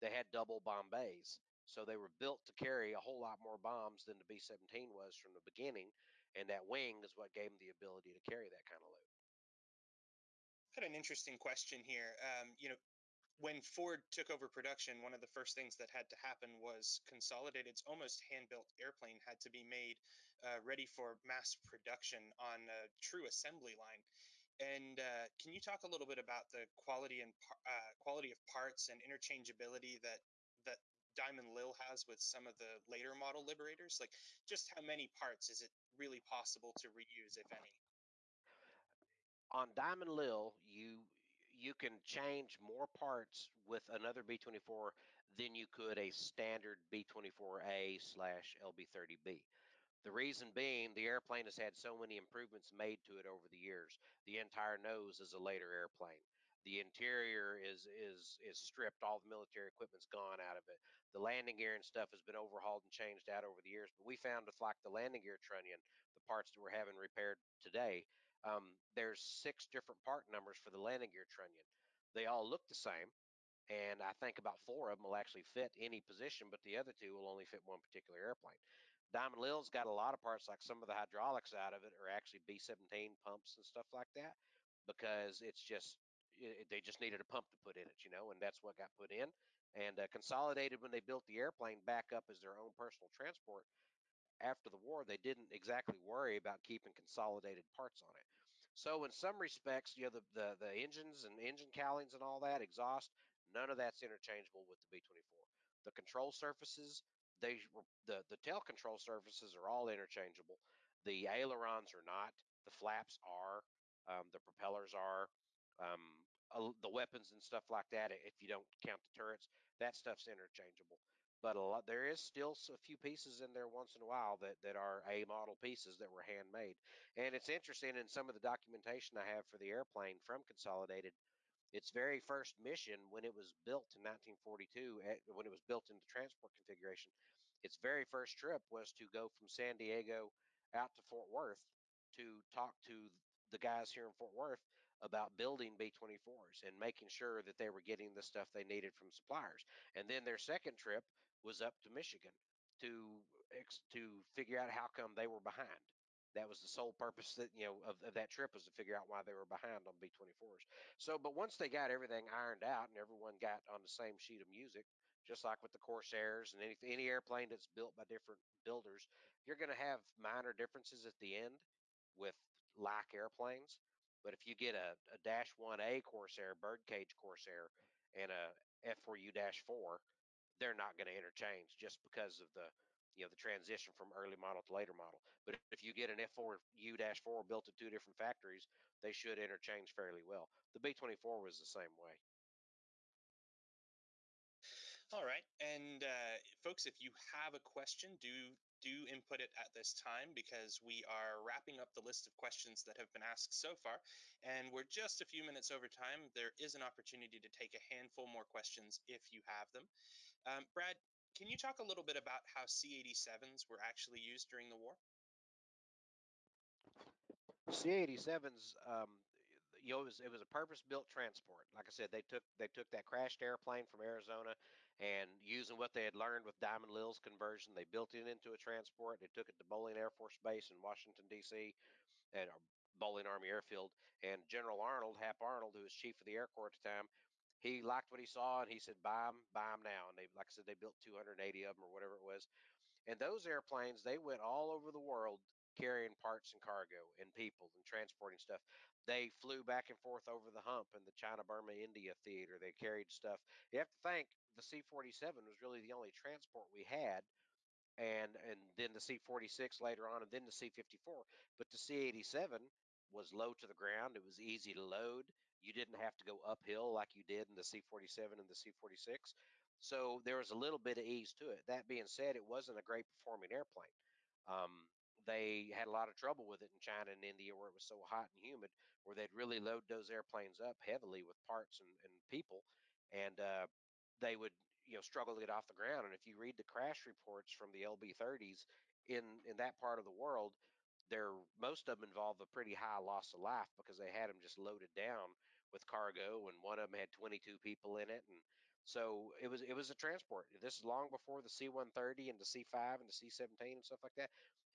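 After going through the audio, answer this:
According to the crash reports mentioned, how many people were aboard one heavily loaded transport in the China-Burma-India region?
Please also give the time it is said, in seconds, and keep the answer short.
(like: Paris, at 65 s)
22, at 297 s.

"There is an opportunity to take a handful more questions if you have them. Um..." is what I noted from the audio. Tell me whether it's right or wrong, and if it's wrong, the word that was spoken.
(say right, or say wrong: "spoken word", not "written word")
right.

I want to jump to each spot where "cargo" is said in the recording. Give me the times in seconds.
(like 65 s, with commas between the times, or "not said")
246 s, 295 s.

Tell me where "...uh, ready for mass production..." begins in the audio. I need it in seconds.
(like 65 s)
20 s.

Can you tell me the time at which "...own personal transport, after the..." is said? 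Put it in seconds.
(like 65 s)
92 s.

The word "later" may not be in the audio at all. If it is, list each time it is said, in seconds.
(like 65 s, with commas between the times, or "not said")
32 s, 55 s, 184 s, 259 s.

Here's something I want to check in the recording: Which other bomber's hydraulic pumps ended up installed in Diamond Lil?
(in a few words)
B-17.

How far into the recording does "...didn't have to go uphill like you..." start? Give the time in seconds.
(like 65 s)
265 s.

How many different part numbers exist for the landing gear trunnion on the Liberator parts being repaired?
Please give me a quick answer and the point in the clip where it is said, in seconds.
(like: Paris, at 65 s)
6, at 69 s.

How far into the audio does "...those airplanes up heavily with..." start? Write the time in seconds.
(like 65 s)
279 s.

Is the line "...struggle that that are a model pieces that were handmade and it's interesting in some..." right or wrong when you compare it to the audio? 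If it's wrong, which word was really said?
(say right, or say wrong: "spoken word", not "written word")
wrong: "while", not "struggle".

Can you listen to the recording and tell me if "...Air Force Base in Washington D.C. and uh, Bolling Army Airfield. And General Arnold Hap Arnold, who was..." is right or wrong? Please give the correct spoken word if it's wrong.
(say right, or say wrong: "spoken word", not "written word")
right.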